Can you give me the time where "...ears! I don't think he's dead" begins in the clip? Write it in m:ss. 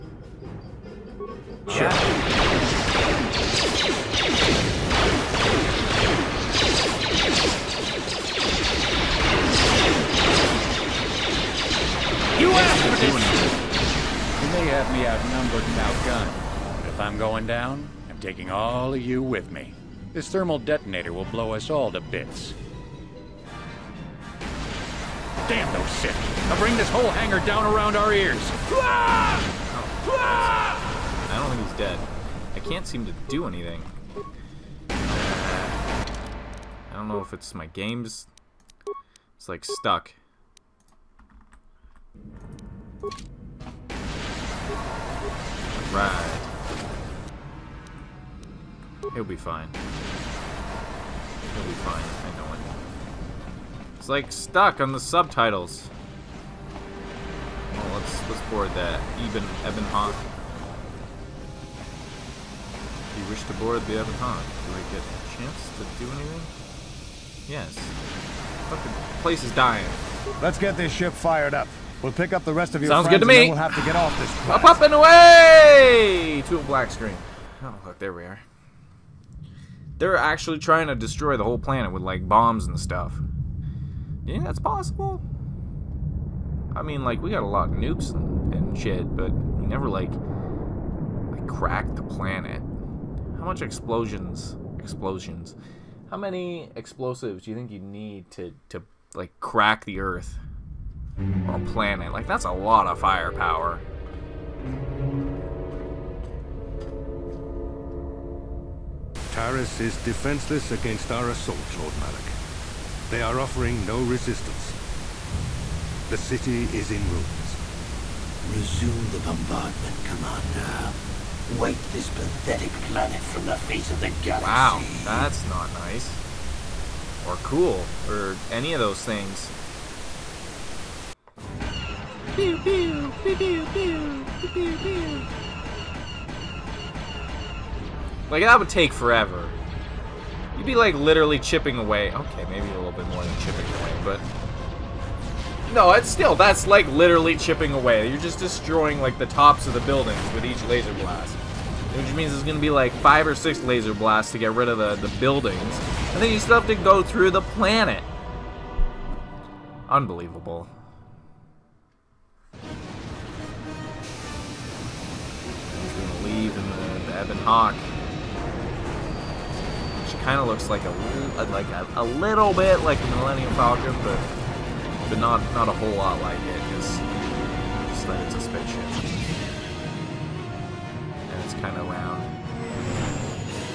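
0:28.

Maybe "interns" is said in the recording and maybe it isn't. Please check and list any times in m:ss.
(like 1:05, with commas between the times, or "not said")
not said.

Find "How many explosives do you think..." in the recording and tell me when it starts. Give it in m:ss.
1:36.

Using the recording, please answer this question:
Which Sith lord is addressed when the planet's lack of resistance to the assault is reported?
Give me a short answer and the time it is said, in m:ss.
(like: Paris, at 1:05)
Lord Malak, at 1:51.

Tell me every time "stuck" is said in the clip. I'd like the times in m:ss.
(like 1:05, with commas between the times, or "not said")
0:39, 0:54.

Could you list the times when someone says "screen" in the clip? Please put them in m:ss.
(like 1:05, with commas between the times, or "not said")
1:16.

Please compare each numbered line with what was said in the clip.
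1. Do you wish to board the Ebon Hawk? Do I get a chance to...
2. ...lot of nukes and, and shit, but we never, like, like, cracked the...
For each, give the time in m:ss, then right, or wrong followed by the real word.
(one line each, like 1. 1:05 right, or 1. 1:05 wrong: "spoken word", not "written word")
1. 1:03 right
2. 1:27 right.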